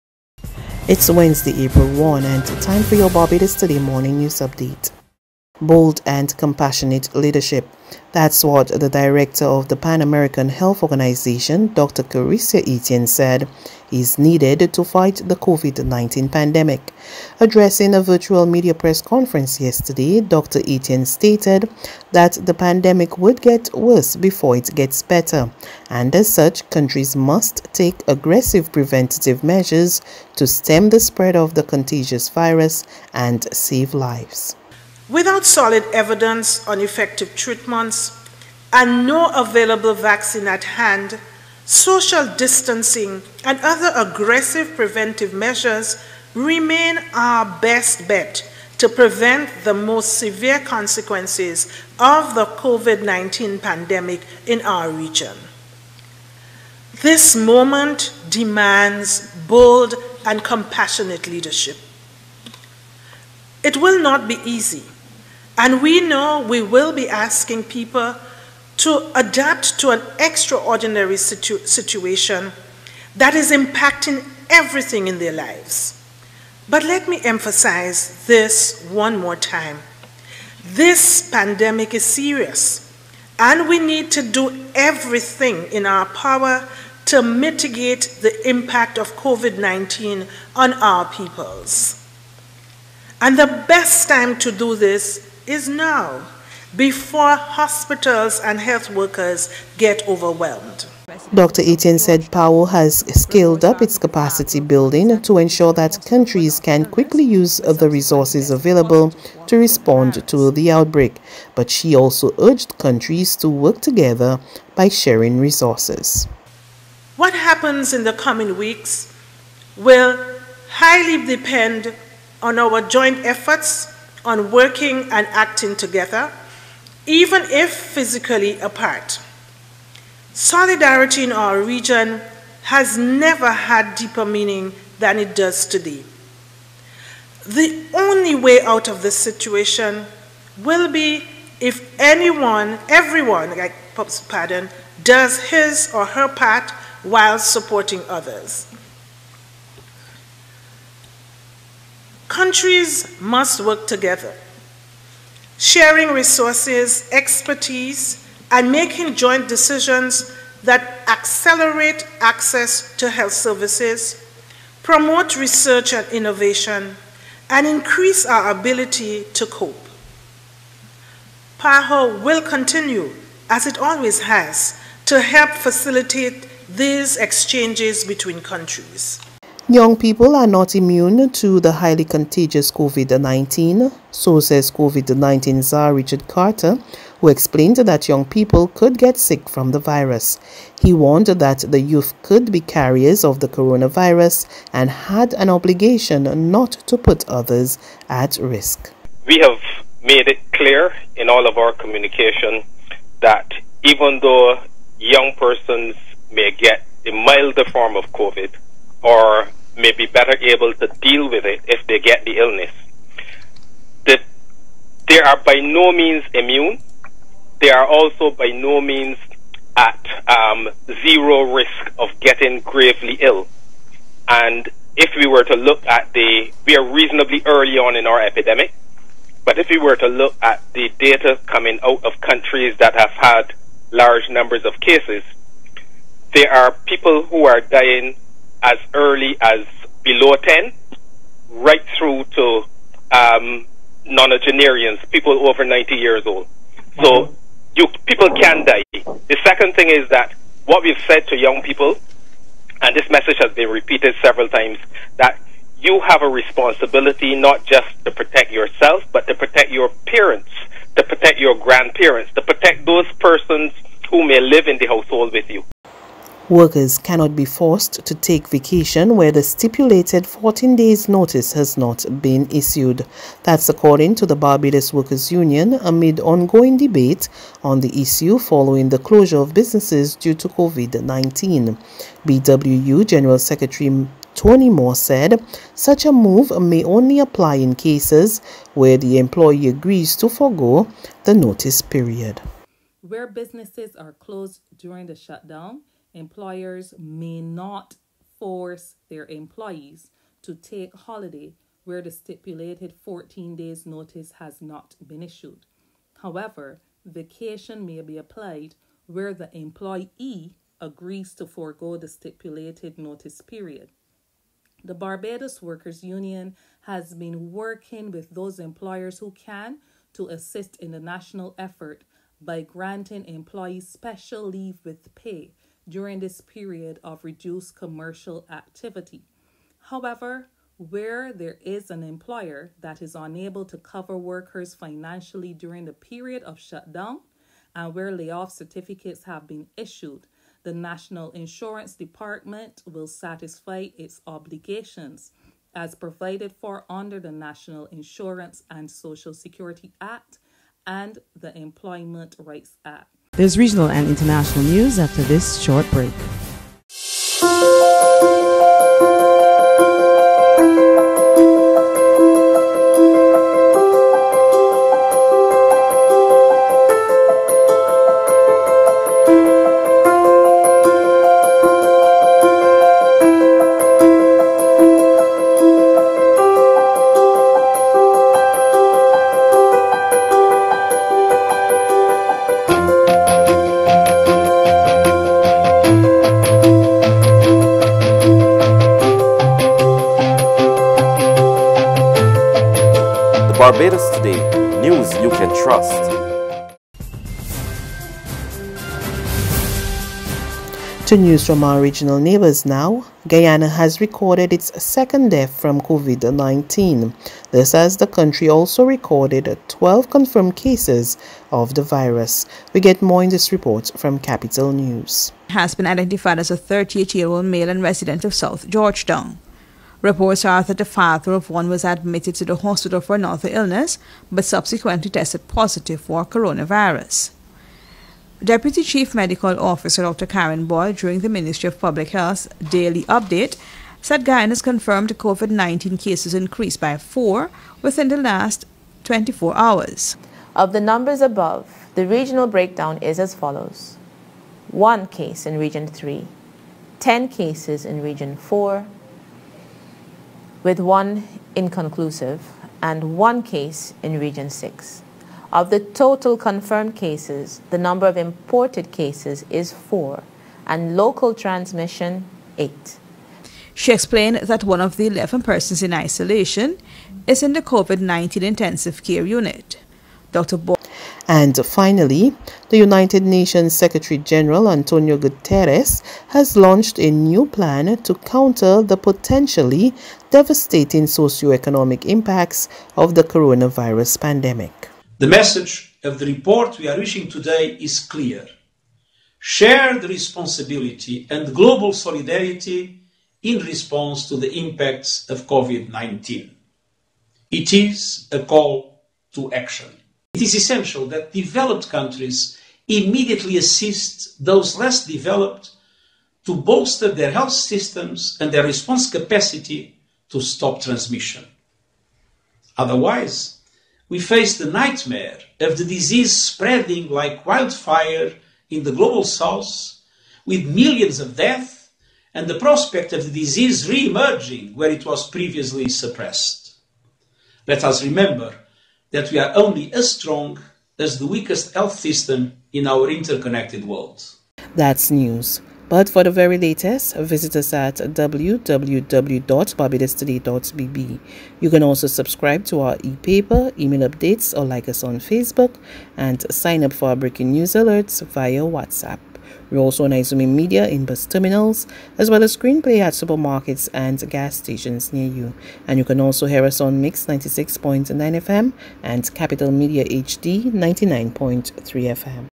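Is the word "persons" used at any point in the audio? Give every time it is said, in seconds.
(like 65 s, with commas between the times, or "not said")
205 s, 263 s, 465 s.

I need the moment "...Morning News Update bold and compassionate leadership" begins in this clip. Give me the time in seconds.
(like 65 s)
3 s.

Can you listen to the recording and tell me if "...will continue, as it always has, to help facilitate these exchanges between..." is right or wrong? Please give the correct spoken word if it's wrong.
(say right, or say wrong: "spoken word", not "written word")
right.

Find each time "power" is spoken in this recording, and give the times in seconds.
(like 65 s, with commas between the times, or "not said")
86 s.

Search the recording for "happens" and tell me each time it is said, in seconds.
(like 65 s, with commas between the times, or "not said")
117 s.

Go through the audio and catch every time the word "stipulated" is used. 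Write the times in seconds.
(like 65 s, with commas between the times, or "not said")
269 s, 302 s, 312 s.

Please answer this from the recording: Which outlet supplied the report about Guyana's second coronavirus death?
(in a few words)
Capitol News.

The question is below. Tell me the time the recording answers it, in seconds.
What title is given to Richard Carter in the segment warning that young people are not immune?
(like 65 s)
184 s.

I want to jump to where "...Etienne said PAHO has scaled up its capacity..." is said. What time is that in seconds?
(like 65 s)
101 s.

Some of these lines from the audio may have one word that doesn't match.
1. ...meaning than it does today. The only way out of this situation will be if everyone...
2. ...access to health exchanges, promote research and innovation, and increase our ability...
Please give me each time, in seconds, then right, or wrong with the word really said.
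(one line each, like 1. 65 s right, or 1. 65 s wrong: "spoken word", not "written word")
1. 134 s wrong: "anyone", not "everyone"
2. 162 s wrong: "services", not "exchanges".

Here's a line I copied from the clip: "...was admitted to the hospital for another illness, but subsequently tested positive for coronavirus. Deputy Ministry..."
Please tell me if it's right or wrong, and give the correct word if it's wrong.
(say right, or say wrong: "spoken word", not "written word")
wrong: "Chief", not "Ministry".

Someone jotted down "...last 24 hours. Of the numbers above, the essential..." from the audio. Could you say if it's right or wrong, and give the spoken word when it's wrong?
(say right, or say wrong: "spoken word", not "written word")
wrong: "regional", not "essential".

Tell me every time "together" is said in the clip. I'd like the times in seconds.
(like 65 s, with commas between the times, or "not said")
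113 s, 125 s, 153 s.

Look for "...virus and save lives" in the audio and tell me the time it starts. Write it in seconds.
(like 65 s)
32 s.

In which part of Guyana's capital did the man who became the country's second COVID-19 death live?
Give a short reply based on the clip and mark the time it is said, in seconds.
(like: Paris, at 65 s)
South Georgetown, at 418 s.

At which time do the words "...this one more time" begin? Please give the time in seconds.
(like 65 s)
78 s.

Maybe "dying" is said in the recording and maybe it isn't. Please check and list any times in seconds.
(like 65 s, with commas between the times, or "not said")
237 s.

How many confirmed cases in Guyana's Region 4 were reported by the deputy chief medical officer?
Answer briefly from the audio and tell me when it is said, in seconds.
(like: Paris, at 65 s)
10, at 446 s.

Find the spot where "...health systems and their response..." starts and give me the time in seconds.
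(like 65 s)
507 s.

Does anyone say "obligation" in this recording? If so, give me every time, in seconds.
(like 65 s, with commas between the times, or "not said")
195 s, 344 s.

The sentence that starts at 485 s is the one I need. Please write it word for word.
The message of the report we are issuing today is clear.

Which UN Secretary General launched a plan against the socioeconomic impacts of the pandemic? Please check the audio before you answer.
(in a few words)
Antonio Guterres.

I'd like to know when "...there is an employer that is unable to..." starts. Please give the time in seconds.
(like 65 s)
331 s.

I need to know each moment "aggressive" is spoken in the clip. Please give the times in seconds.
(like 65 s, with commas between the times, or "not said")
28 s, 43 s.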